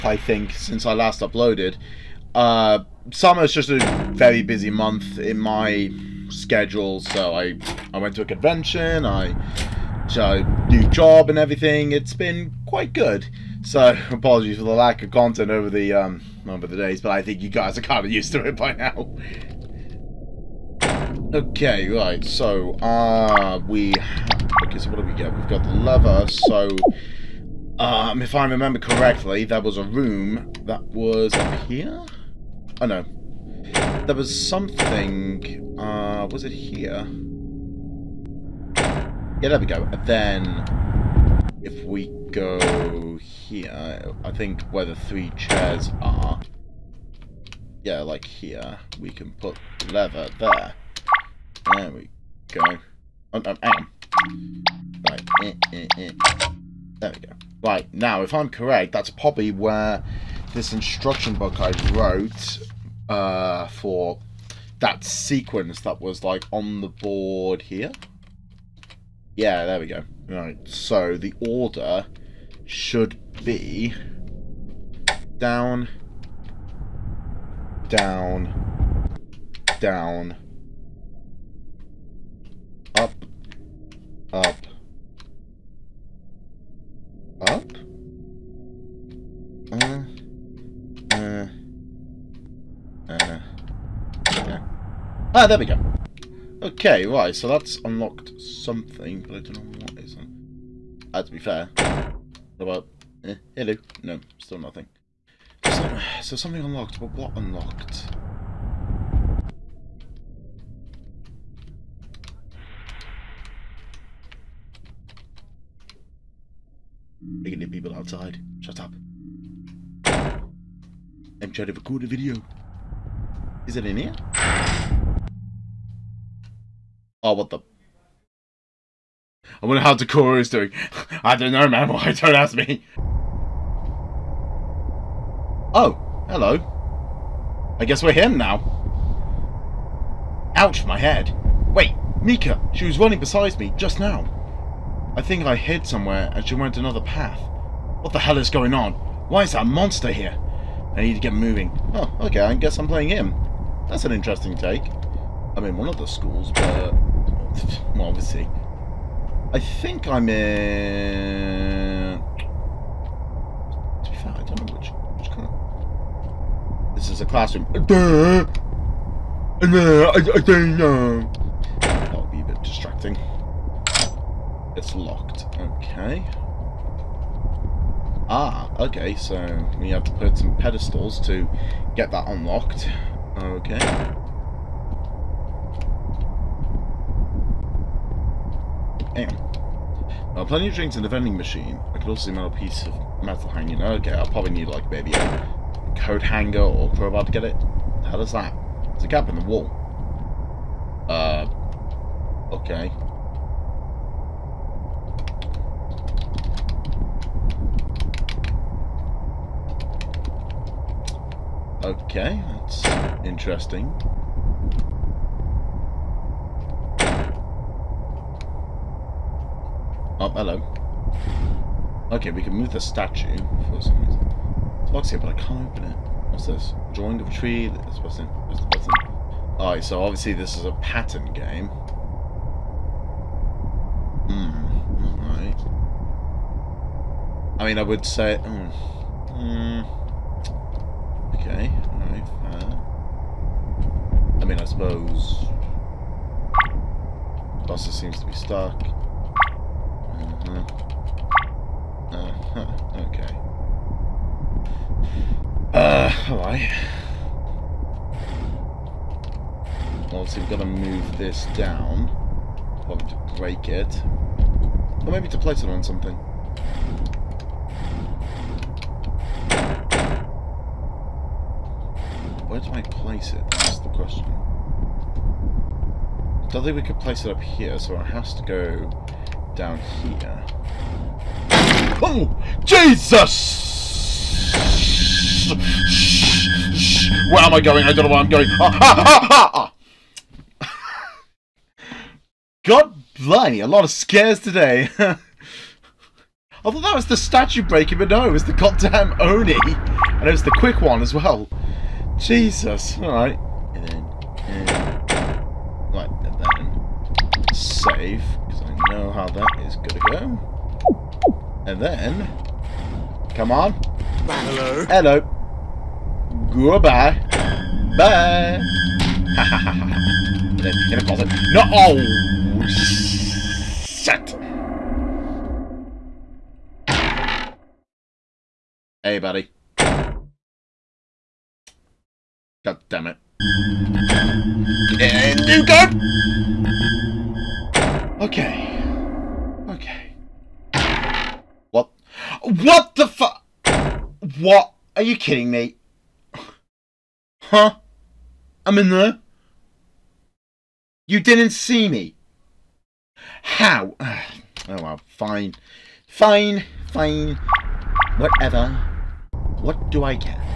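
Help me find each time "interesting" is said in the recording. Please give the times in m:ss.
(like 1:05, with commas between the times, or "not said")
2:34, 3:33.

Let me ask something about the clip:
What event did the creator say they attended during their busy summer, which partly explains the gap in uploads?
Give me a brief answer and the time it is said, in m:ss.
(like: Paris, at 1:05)
A convention, at 0:08.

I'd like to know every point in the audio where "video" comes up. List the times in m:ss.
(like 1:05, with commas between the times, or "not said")
2:02.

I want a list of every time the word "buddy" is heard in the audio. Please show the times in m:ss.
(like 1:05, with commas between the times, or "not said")
5:29.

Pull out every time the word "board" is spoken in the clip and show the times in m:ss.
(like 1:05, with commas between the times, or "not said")
1:06.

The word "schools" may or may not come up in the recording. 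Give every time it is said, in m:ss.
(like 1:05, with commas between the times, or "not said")
2:36.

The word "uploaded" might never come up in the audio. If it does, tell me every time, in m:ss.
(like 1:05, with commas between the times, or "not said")
0:01.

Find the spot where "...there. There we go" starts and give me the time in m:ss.
0:50.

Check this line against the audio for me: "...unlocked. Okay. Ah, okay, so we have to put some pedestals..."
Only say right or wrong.
wrong.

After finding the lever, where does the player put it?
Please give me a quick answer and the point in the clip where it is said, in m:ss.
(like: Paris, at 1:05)
Where the three chairs are, at 0:44.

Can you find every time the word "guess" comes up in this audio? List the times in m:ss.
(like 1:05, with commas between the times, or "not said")
2:17, 2:32.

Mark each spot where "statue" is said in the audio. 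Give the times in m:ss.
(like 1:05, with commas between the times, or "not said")
3:42, 4:57.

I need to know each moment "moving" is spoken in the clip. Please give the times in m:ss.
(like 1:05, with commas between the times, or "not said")
2:31.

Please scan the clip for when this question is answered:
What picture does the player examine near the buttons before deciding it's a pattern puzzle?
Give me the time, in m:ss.
3:46.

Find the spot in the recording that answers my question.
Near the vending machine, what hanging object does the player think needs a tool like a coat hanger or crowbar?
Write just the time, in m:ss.
3:12.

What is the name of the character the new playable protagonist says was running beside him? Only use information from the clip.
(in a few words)
Mika.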